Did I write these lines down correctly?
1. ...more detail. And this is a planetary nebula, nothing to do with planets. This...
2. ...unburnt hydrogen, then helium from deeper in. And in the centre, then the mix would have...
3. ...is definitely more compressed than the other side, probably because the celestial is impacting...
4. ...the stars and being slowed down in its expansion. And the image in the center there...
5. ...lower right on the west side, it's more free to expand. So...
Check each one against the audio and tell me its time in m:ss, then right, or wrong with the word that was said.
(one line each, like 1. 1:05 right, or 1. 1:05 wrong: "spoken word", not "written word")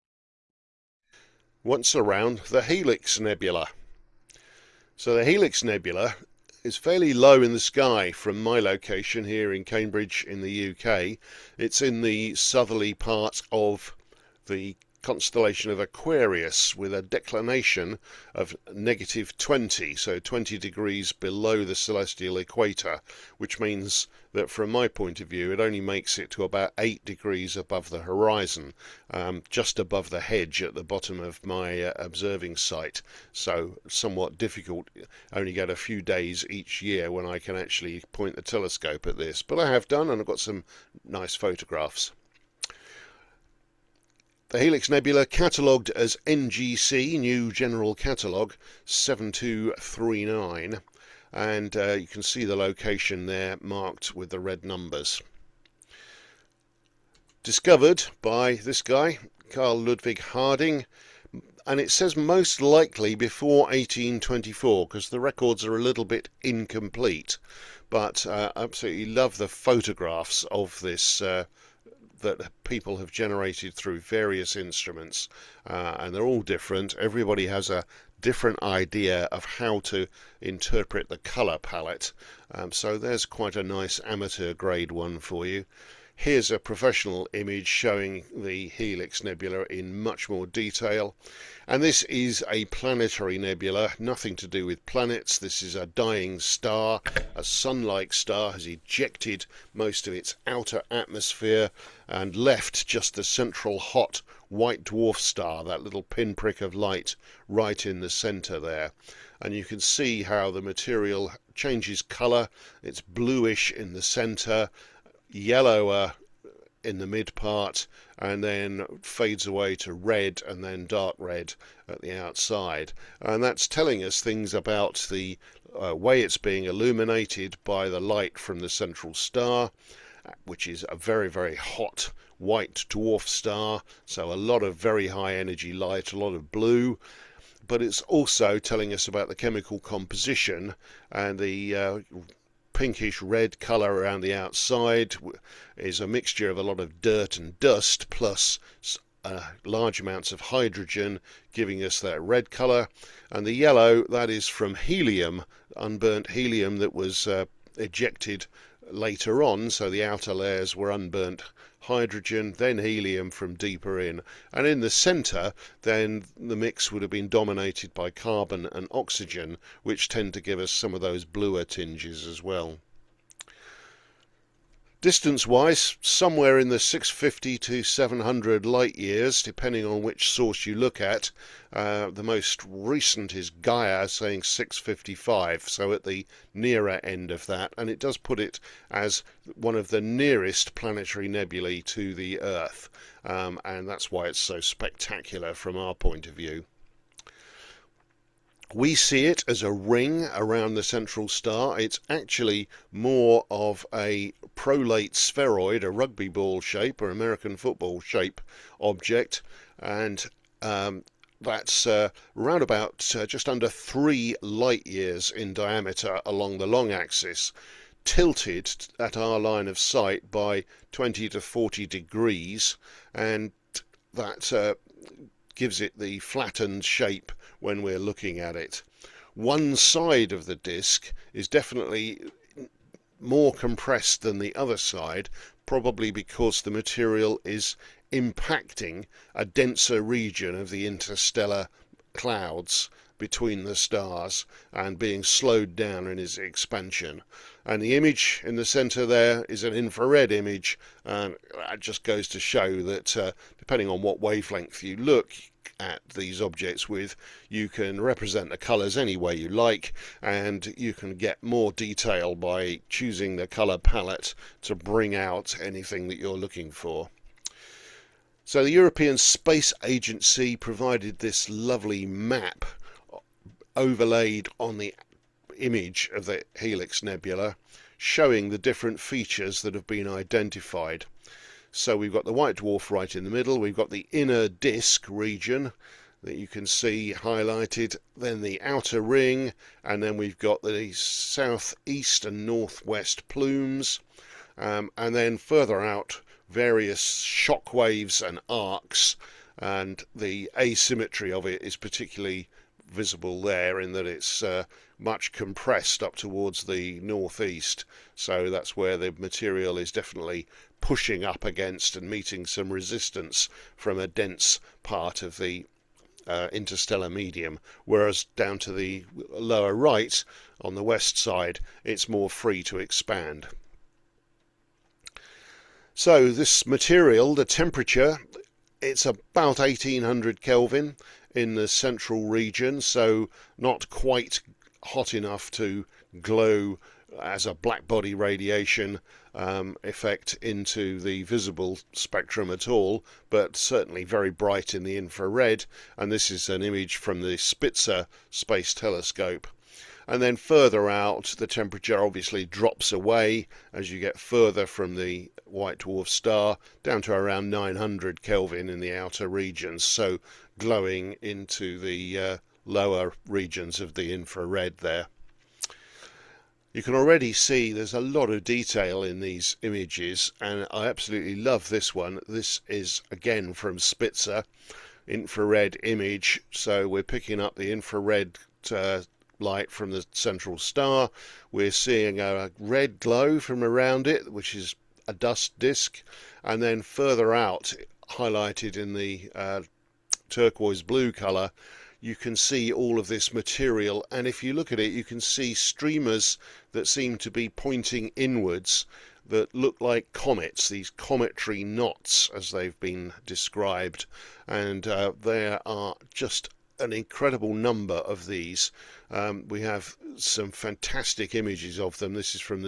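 1. 1:30 right
2. 2:40 right
3. 3:51 wrong: "material", not "celestial"
4. 4:03 right
5. 5:19 right.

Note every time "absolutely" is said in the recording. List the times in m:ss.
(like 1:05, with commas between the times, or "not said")
1:08, 6:10.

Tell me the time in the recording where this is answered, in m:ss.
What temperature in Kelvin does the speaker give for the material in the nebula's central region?
5:29.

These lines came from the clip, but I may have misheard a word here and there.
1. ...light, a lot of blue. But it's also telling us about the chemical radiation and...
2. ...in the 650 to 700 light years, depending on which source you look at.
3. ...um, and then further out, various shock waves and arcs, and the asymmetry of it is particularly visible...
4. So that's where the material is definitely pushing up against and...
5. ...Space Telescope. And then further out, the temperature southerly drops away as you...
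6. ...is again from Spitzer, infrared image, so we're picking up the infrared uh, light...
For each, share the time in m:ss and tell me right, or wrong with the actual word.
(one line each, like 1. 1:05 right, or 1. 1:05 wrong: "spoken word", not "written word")
1. 2:15 wrong: "composition", not "radiation"
2. 2:56 right
3. 4:54 right
4. 5:08 right
5. 5:48 wrong: "obviously", not "southerly"
6. 6:12 right.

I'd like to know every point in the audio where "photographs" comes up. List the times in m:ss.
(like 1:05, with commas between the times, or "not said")
0:41, 1:09.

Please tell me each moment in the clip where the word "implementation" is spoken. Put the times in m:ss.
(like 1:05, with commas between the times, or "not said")
not said.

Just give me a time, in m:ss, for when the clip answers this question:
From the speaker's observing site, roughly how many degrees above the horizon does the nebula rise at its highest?
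0:26.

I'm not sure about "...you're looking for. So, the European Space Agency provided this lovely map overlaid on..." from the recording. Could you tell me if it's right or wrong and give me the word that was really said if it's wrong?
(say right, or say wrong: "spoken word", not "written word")
right.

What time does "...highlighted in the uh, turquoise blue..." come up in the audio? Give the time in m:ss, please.
6:28.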